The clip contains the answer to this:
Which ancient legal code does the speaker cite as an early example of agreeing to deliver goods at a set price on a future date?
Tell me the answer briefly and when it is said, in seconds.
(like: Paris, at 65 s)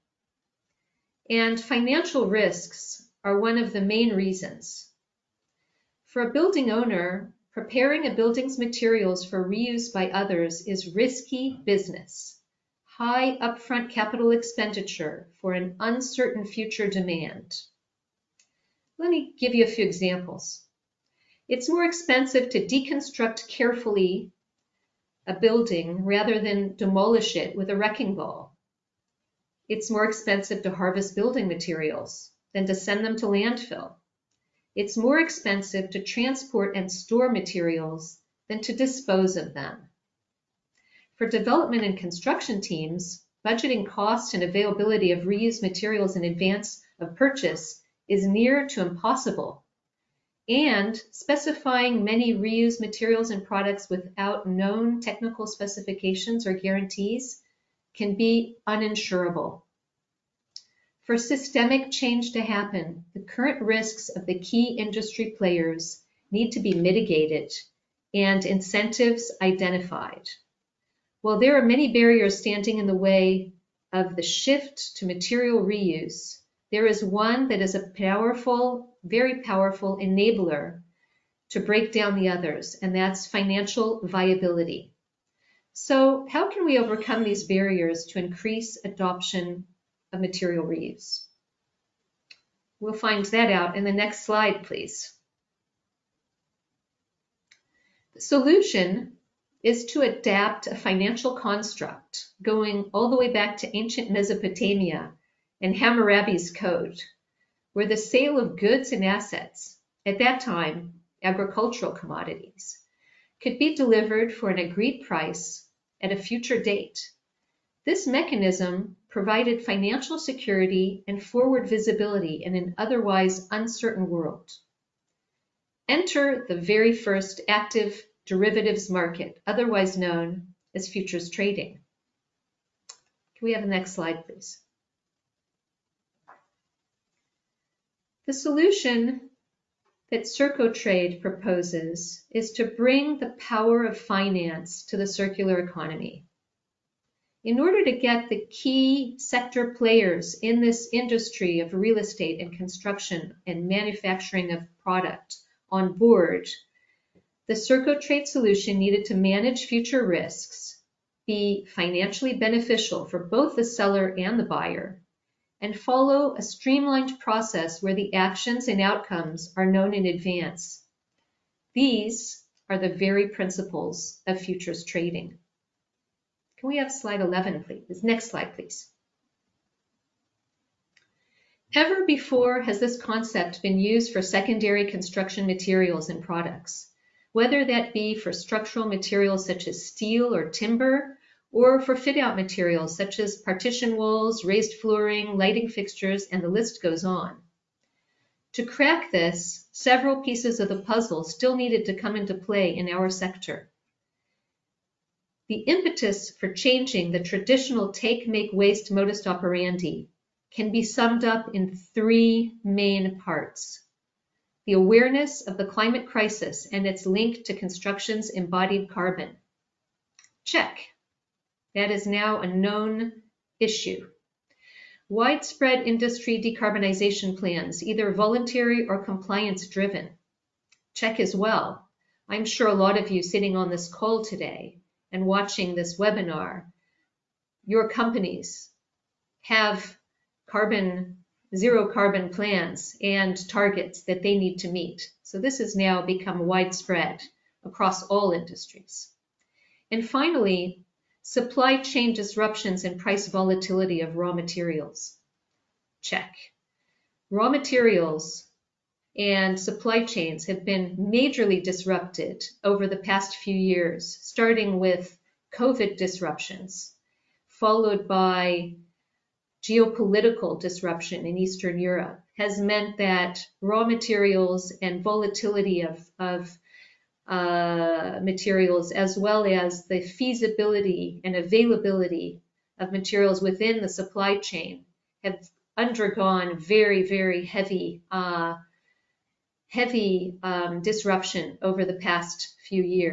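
Hammurabi's Code, at 105 s.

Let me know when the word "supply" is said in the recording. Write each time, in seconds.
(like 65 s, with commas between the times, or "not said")
251 s, 259 s, 283 s.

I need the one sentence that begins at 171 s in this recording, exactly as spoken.
These are the very principles of futures trading.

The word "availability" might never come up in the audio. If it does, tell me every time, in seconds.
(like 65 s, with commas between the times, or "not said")
44 s, 281 s.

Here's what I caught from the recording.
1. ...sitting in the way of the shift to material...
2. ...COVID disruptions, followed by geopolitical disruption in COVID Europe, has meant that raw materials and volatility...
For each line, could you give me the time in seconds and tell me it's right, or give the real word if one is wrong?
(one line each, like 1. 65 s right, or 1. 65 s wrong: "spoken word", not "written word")
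1. 72 s wrong: "standing", not "sitting"
2. 265 s wrong: "Eastern", not "COVID".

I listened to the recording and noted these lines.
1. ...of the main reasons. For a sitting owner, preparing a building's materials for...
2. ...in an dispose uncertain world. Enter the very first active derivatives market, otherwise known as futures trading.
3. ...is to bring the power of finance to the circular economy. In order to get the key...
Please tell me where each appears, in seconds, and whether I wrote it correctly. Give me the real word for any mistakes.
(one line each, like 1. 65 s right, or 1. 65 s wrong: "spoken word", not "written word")
1. 3 s wrong: "building", not "sitting"
2. 122 s wrong: "otherwise", not "dispose"
3. 142 s right.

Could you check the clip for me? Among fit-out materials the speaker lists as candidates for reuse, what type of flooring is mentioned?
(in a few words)
raised flooring.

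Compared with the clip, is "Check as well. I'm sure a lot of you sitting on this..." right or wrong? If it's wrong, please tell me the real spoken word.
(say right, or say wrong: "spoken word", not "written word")
right.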